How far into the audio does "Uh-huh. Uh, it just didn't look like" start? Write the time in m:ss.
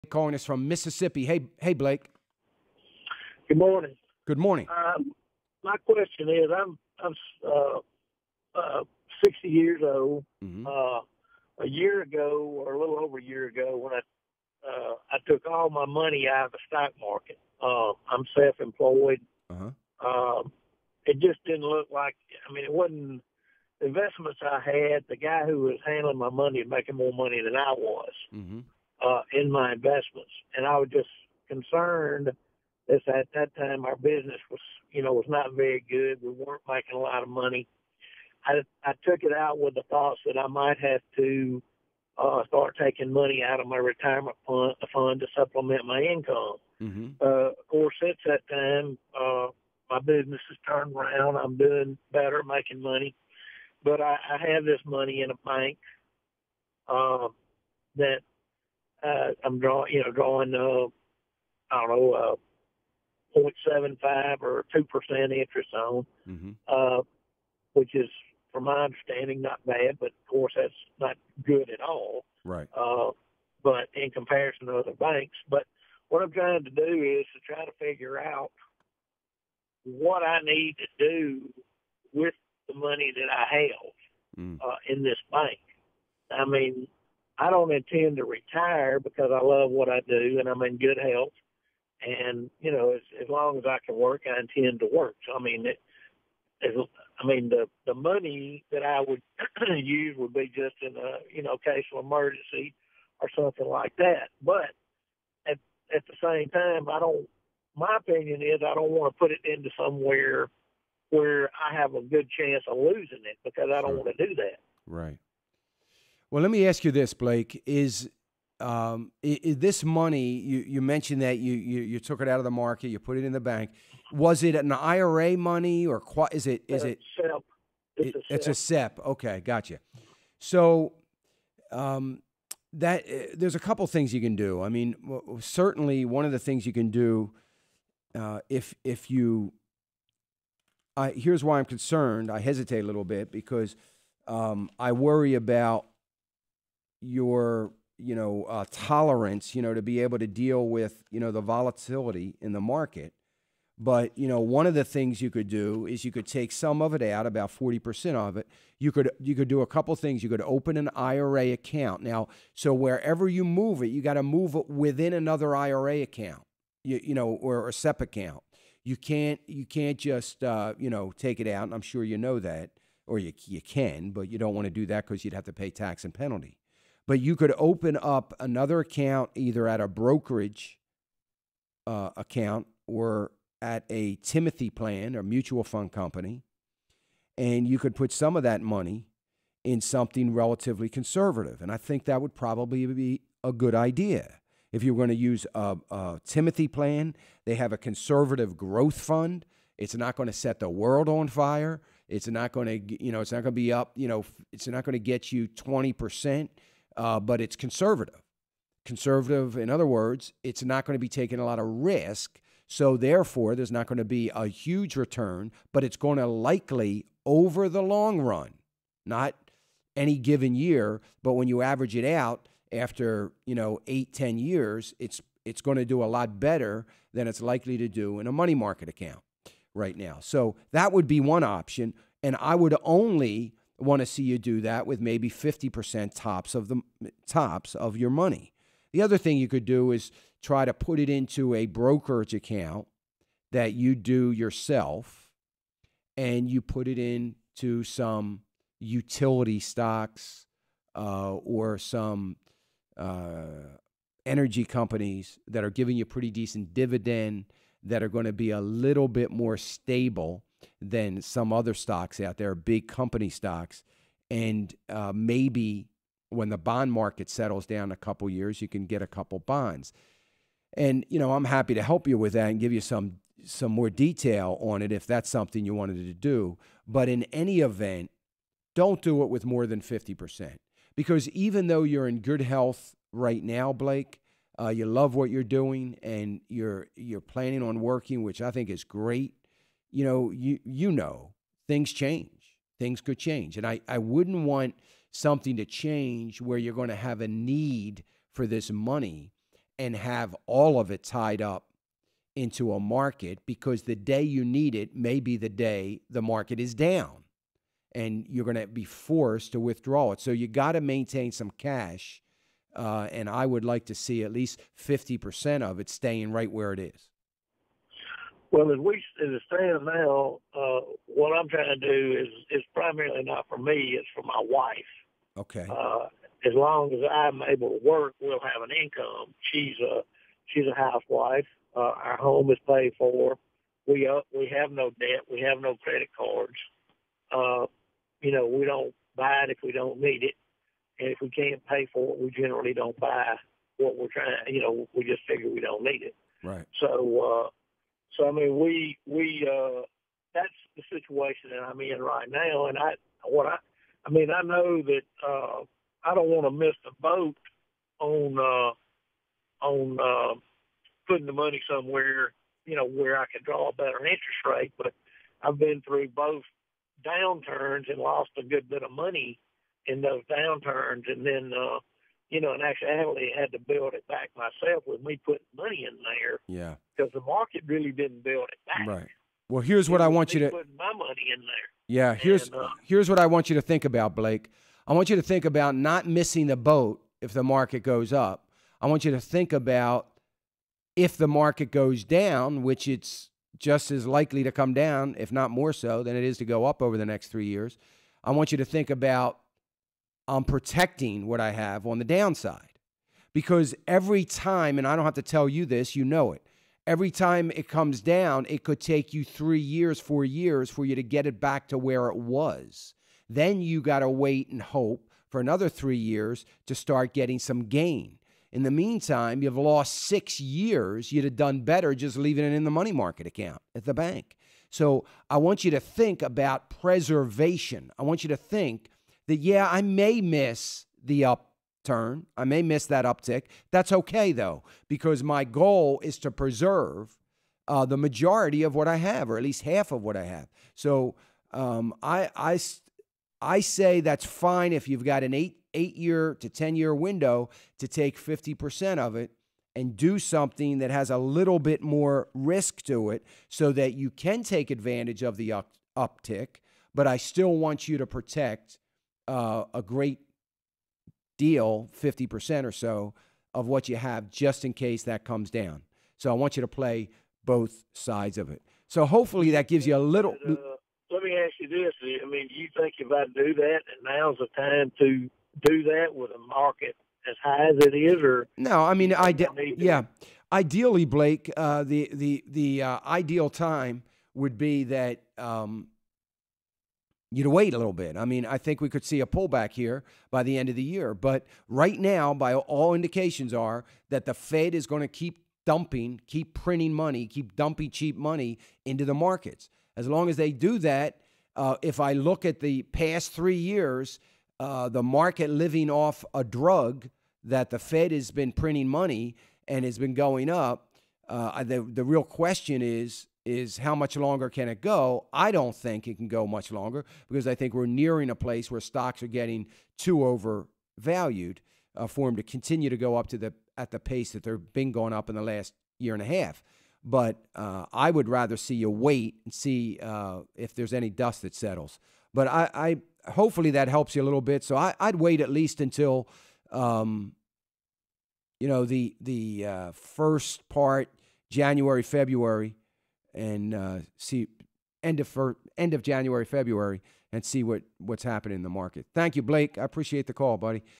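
0:19.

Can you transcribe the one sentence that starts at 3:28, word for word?
Conservative, in other words, it's not going to be taking a lot of risk.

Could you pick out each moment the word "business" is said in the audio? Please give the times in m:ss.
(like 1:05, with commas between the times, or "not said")
0:33, 0:49.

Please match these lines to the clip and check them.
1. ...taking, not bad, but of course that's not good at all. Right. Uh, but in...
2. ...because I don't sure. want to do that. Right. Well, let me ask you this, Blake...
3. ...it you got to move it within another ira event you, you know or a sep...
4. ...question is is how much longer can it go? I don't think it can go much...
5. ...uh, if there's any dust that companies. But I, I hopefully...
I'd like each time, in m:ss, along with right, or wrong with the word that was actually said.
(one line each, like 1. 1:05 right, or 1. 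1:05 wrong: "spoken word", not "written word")
1. 1:08 wrong: "understanding", not "taking"
2. 1:53 right
3. 2:43 wrong: "account", not "event"
4. 8:32 right
5. 8:50 wrong: "settles", not "companies".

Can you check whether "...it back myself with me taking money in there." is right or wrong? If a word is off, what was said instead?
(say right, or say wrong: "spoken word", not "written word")
wrong: "putting", not "taking".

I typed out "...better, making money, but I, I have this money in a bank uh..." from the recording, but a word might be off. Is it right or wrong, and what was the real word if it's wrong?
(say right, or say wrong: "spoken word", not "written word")
right.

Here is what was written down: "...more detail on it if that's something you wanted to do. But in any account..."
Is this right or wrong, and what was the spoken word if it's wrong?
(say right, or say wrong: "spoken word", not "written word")
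wrong: "event", not "account".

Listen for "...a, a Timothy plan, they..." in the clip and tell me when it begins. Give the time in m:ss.
3:15.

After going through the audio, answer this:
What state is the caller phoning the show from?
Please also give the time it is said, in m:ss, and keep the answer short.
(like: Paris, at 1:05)
Mississippi, at 0:00.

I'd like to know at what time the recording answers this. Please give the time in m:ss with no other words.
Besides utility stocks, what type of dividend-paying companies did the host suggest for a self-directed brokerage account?
4:14.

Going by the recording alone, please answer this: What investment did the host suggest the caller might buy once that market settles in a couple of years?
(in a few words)
bonds.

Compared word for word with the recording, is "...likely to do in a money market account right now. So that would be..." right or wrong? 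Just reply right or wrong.
right.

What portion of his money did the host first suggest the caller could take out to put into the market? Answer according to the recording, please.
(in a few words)
40%.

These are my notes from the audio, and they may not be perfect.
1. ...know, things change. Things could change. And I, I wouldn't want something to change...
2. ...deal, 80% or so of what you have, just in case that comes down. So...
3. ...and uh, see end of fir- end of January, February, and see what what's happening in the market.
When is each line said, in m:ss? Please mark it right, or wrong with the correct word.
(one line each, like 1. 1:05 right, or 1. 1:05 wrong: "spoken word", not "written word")
1. 4:50 right
2. 7:41 wrong: "50", not "80"
3. 9:03 right.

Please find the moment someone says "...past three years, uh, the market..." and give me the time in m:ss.
8:22.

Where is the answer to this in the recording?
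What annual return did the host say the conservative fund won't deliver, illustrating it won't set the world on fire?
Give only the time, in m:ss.
3:25.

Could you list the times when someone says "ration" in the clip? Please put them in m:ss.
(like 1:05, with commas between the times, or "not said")
not said.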